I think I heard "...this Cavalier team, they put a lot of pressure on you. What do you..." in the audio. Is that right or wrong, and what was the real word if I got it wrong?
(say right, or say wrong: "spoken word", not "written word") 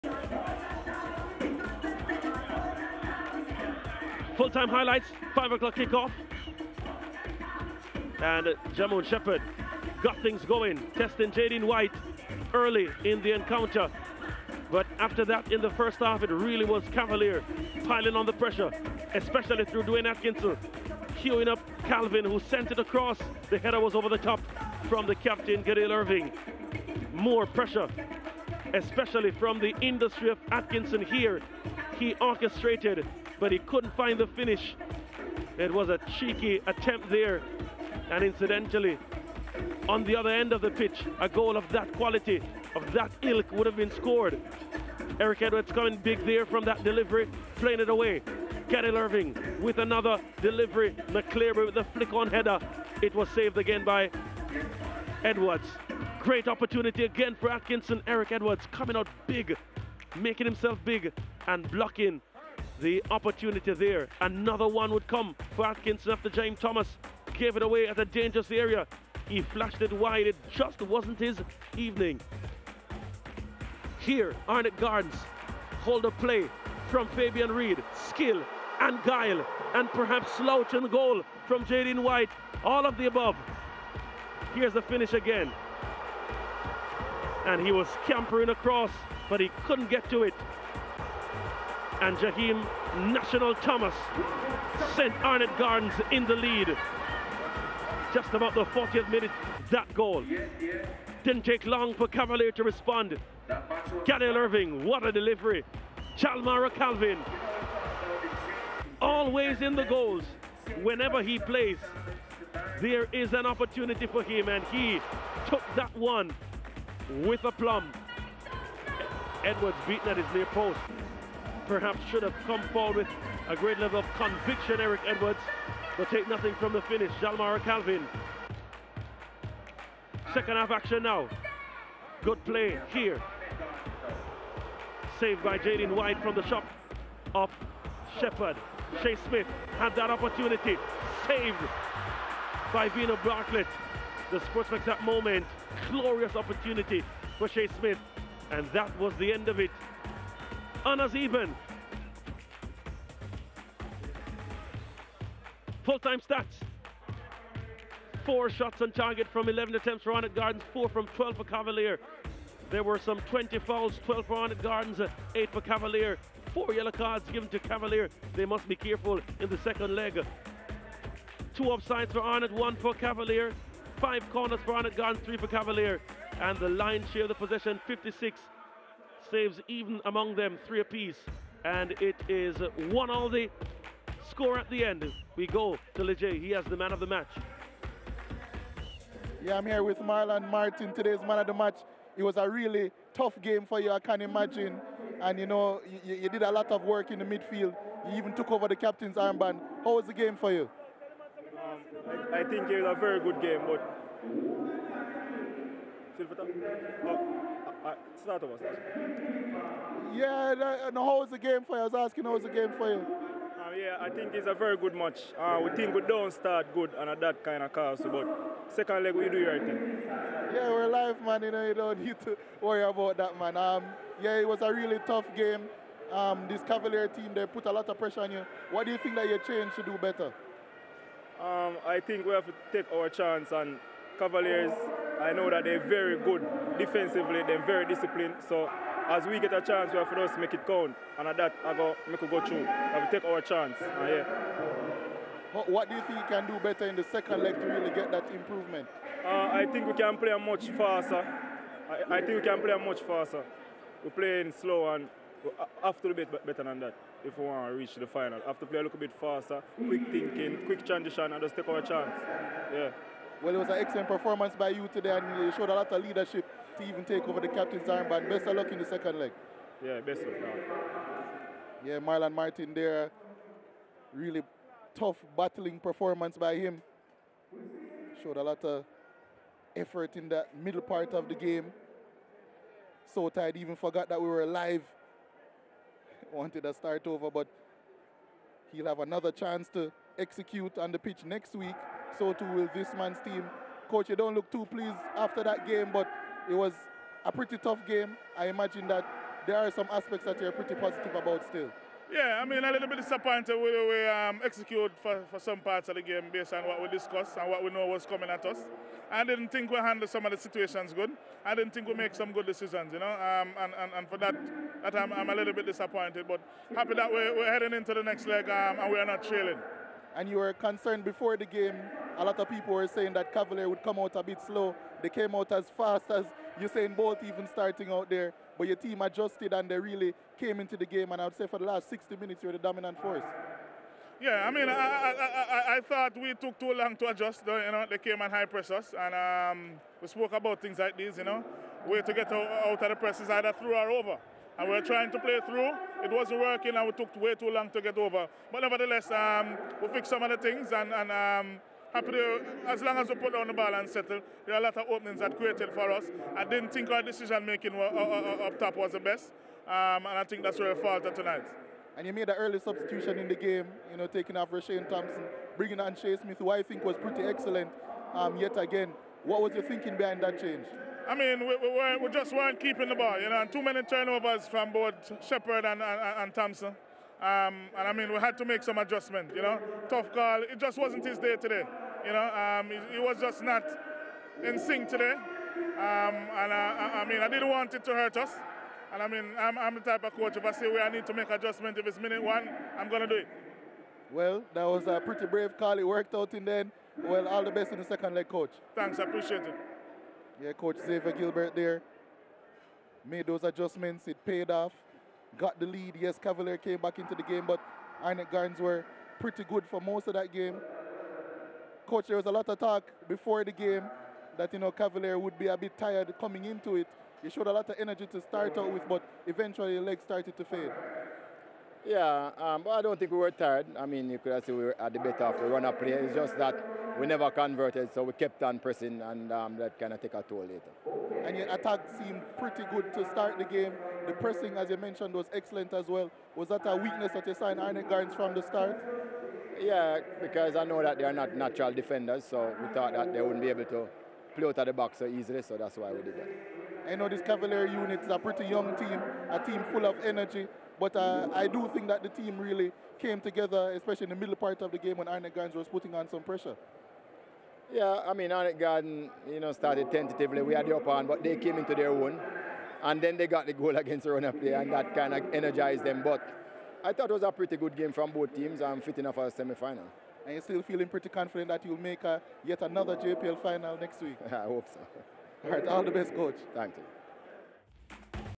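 right.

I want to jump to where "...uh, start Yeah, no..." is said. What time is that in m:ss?
3:27.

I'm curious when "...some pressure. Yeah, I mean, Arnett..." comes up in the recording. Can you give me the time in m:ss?
7:36.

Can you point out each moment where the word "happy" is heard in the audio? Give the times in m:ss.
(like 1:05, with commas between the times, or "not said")
5:16, 5:51.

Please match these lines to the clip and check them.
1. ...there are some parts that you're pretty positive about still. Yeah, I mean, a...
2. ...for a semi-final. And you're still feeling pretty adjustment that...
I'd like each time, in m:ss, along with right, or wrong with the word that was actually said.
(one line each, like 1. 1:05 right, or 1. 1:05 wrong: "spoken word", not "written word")
1. 4:59 wrong: "aspects", not "parts"
2. 7:49 wrong: "confident", not "adjustment".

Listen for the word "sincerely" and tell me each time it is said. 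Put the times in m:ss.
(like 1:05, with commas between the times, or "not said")
not said.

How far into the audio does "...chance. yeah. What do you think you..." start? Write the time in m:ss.
4:03.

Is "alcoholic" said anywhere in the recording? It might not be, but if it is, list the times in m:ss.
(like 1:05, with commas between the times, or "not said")
not said.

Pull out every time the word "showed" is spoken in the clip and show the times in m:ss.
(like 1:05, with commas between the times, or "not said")
4:25, 4:38, 6:57.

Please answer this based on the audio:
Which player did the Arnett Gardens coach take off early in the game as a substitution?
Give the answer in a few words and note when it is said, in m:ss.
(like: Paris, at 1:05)
Rashane Thompson, at 6:04.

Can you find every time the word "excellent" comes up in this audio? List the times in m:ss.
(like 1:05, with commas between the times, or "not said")
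4:23, 6:07, 7:15.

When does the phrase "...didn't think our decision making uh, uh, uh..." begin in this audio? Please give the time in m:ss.
5:56.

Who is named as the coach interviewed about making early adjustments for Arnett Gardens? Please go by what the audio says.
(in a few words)
Xavier Gilbert.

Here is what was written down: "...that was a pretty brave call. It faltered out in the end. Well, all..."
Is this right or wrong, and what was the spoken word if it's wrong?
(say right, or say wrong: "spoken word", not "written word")
wrong: "worked", not "faltered".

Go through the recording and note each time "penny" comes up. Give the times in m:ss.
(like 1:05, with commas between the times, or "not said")
not said.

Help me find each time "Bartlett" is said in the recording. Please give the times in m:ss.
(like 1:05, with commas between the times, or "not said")
2:23.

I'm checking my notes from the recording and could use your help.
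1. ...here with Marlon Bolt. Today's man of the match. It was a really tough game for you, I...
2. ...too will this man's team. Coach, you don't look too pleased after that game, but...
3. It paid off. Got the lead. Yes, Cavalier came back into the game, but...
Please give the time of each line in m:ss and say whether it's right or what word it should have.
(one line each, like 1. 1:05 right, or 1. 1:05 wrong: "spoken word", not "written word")
1. 3:09 wrong: "Martin", not "Bolt"
2. 4:52 right
3. 6:44 right.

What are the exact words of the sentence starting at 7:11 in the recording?
And your attack seemed pretty good to start the game.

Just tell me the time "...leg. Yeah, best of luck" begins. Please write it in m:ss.
4:29.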